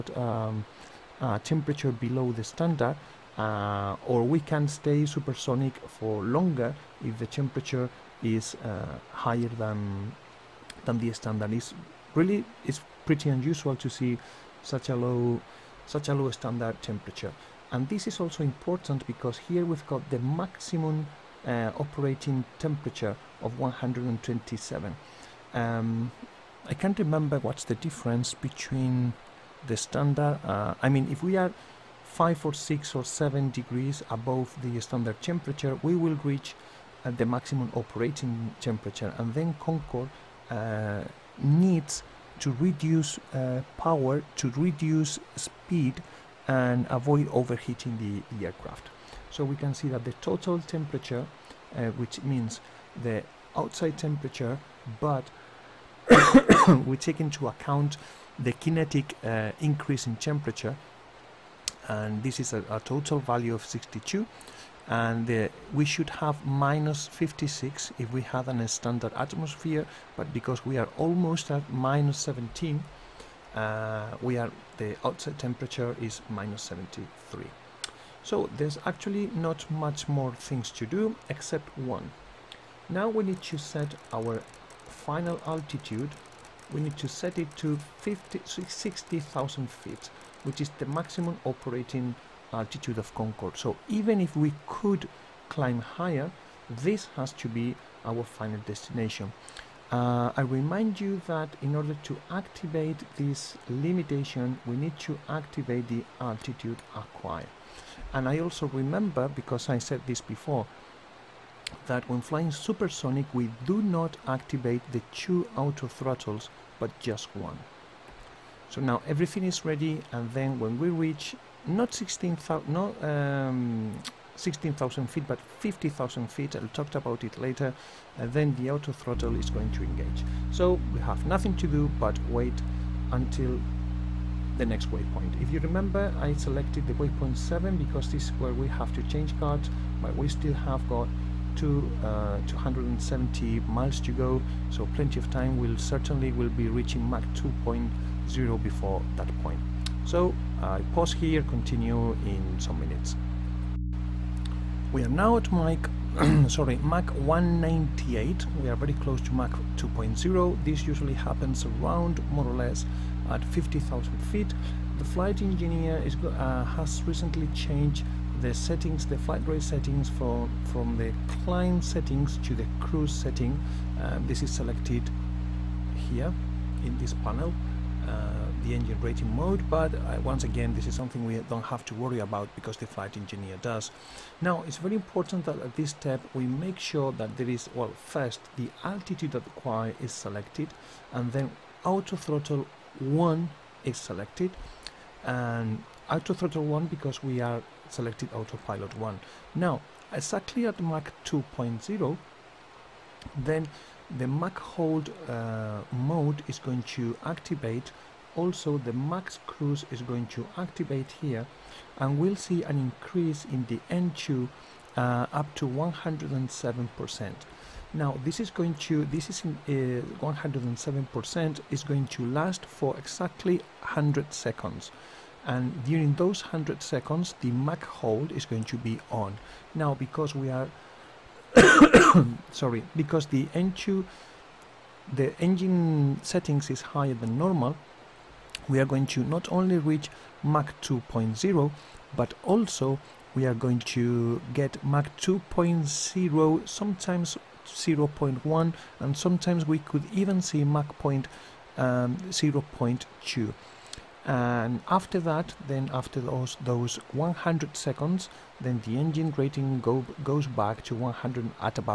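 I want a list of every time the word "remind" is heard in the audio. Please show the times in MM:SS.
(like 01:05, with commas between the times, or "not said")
01:40.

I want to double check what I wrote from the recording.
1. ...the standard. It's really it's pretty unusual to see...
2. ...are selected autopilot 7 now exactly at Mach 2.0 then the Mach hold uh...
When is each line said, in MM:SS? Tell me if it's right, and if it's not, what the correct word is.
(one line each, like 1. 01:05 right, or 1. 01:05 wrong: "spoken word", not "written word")
1. 00:10 right
2. 03:17 wrong: "1", not "7".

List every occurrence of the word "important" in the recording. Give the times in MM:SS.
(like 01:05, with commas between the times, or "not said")
00:18, 03:04.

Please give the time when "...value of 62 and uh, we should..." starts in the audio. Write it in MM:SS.
01:03.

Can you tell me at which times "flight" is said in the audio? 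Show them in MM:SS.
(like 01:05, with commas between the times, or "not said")
02:45, 02:49, 03:02.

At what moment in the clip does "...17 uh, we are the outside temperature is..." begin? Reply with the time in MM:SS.
01:12.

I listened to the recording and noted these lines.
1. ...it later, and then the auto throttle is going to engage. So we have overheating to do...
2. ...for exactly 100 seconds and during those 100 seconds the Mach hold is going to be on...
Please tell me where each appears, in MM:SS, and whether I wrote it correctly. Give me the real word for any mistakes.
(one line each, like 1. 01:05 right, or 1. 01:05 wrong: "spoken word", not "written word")
1. 02:07 wrong: "nothing", not "overheating"
2. 03:42 right.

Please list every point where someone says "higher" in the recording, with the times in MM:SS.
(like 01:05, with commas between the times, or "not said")
00:09, 01:35, 03:56.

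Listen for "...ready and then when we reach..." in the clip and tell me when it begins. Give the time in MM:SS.
01:59.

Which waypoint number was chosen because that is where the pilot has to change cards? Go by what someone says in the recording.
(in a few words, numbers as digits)
7.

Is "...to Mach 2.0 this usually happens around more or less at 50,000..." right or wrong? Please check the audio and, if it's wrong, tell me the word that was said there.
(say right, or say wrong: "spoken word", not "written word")
right.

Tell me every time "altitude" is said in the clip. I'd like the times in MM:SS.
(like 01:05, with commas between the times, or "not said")
01:25, 01:32, 01:46, 03:08.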